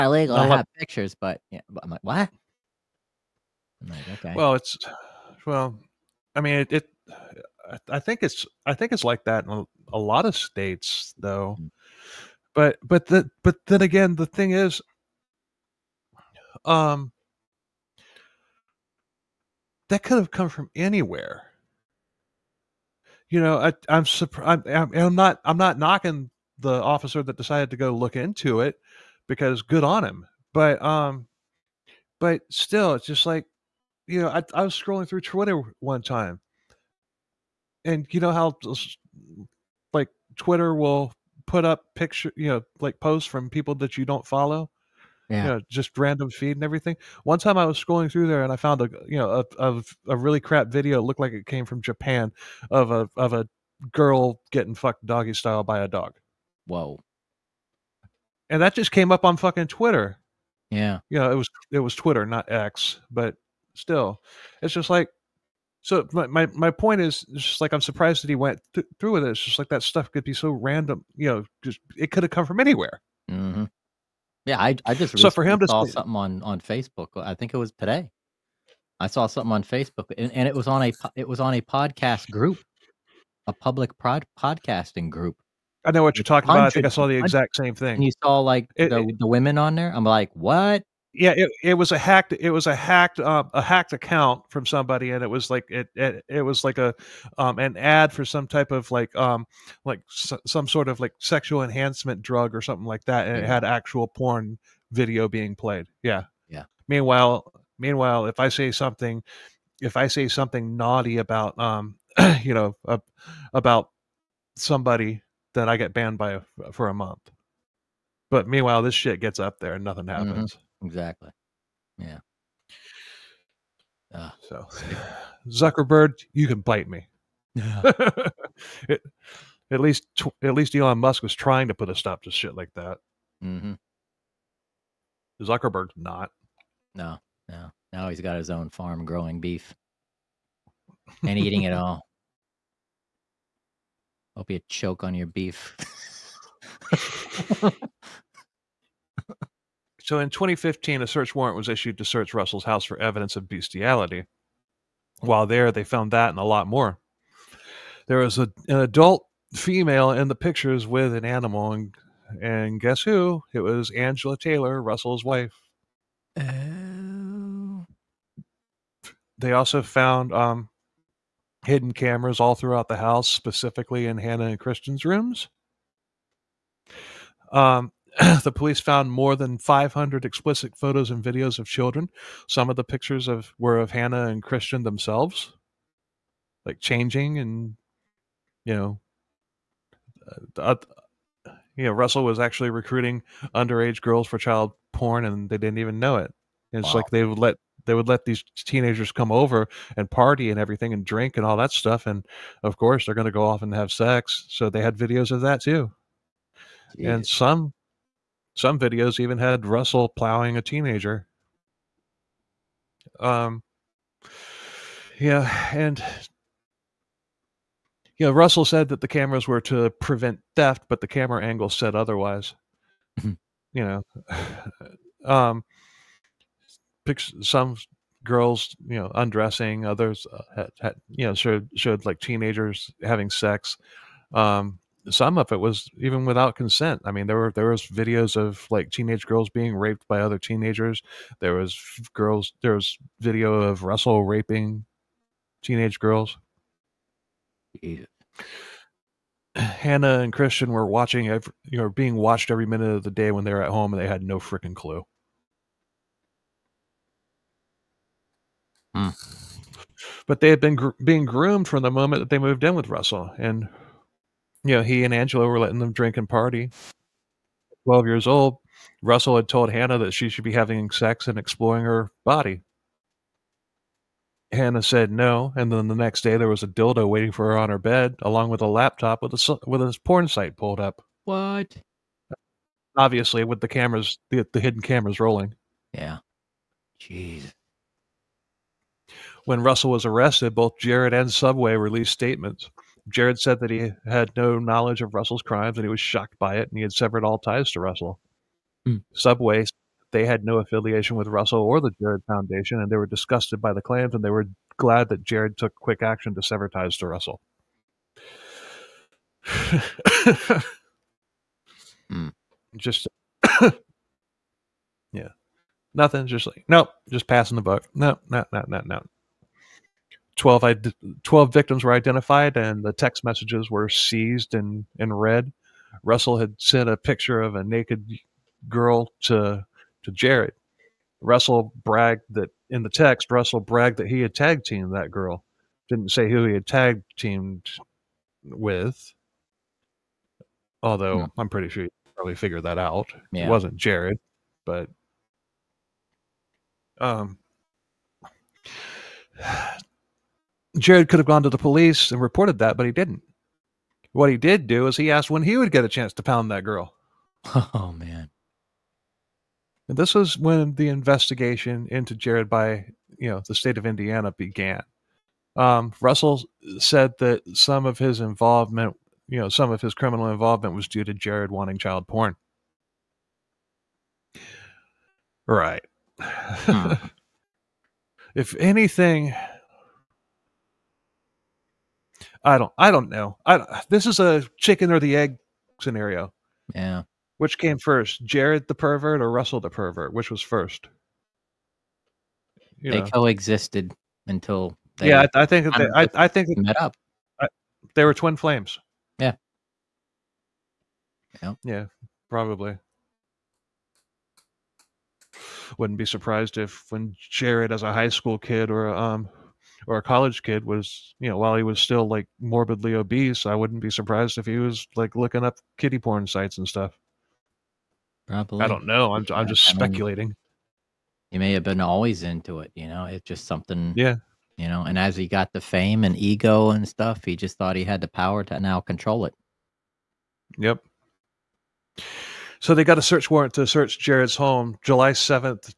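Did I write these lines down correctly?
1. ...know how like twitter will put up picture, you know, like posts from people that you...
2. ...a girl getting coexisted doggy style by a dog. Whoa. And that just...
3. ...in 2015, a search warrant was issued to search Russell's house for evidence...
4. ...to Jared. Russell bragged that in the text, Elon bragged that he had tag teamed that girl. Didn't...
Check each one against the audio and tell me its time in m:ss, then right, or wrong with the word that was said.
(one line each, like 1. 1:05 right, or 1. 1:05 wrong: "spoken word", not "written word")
1. 0:38 right
2. 0:53 wrong: "fucked", not "coexisted"
3. 2:30 right
4. 5:30 wrong: "Russell", not "Elon".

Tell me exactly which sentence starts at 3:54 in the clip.
Um, some of it was even without consent.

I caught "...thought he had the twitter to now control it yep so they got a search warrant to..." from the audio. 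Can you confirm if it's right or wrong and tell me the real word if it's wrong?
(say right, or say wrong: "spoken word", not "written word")
wrong: "power", not "twitter".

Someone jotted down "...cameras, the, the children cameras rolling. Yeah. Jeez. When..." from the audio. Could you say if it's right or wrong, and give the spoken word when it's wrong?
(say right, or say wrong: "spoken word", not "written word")
wrong: "hidden", not "children".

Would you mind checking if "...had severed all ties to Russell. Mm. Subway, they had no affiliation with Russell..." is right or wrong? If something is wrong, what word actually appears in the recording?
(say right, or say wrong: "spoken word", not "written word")
right.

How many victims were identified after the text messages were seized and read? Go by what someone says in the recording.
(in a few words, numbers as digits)
12.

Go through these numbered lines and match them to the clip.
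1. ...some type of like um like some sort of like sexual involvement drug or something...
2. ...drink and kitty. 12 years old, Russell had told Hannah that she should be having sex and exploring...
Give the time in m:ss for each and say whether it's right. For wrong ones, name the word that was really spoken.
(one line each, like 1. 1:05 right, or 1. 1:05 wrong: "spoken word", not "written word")
1. 1:38 wrong: "enhancement", not "involvement"
2. 4:25 wrong: "party", not "kitty".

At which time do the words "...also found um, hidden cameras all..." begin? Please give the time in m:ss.
2:49.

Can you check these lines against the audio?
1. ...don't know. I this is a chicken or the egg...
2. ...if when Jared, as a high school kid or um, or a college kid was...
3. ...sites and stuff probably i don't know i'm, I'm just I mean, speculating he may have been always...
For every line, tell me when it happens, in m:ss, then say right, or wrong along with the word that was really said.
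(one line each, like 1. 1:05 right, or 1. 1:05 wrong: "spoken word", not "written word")
1. 6:22 right
2. 6:46 right
3. 6:56 right.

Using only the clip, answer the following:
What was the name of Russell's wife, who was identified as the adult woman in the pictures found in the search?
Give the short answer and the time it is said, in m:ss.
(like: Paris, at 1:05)
Angela Taylor, at 2:43.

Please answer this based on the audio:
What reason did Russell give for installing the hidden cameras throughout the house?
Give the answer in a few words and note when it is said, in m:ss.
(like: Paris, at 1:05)
To prevent theft, at 3:39.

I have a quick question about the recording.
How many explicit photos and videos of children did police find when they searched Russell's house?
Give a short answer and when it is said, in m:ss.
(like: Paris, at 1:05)
more than 500, at 2:59.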